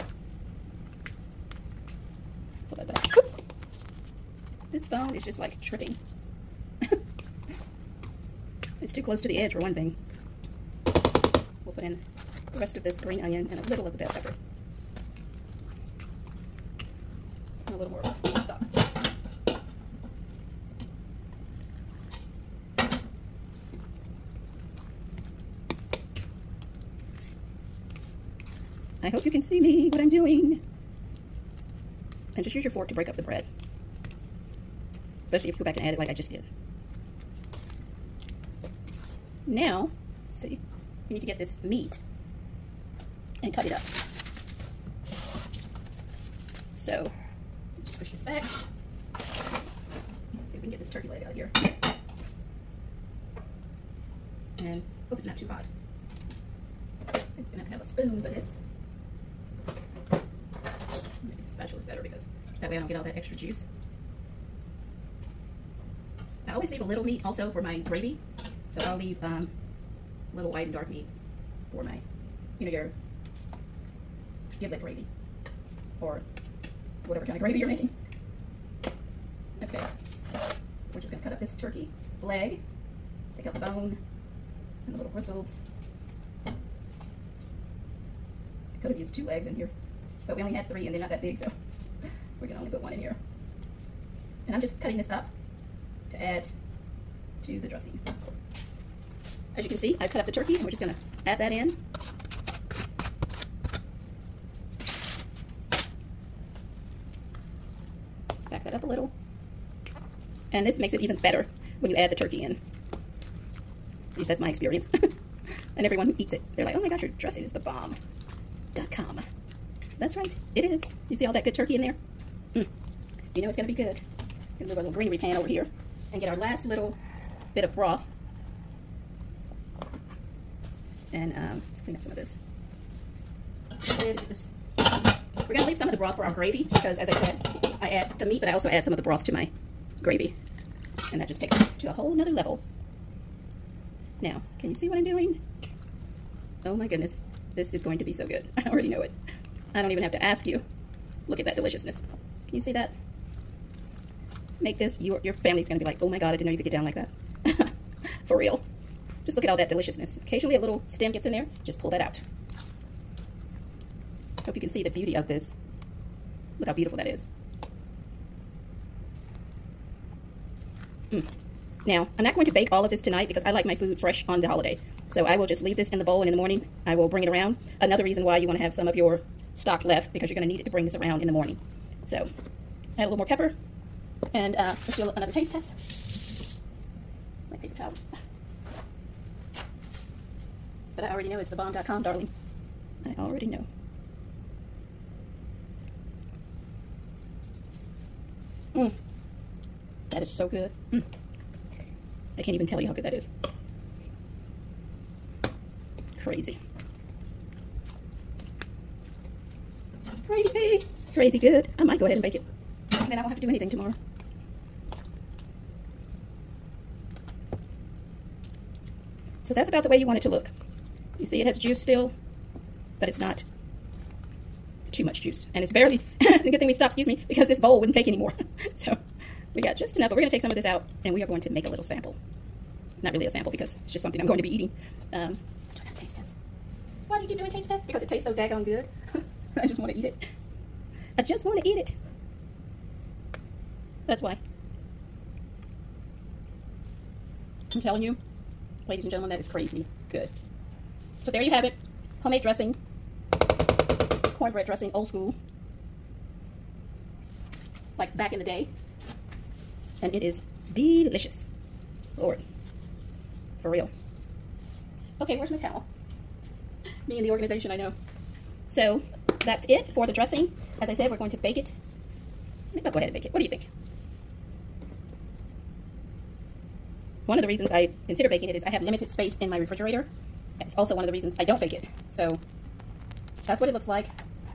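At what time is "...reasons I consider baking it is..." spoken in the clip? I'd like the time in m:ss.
4:37.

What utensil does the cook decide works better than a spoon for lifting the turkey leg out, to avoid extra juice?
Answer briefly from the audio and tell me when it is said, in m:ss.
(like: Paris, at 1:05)
spatula, at 1:01.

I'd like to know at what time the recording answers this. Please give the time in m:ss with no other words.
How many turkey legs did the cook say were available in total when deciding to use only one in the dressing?
1:30.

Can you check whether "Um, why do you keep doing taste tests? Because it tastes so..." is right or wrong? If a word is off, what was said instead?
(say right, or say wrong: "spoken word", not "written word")
right.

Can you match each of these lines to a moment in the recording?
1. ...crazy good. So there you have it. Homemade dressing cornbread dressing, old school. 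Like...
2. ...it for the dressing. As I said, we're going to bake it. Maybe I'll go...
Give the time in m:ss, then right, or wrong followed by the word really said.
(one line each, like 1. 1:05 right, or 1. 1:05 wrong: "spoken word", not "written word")
1. 4:09 right
2. 4:29 right.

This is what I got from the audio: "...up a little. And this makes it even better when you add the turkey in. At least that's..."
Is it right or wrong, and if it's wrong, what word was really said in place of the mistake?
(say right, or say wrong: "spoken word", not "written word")
right.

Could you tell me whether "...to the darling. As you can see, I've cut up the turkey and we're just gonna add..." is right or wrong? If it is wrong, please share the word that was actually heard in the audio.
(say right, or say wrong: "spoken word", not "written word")
wrong: "dressing", not "darling".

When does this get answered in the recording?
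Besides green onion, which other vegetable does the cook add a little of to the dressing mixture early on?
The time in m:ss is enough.
0:13.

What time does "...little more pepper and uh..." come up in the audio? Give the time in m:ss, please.
3:03.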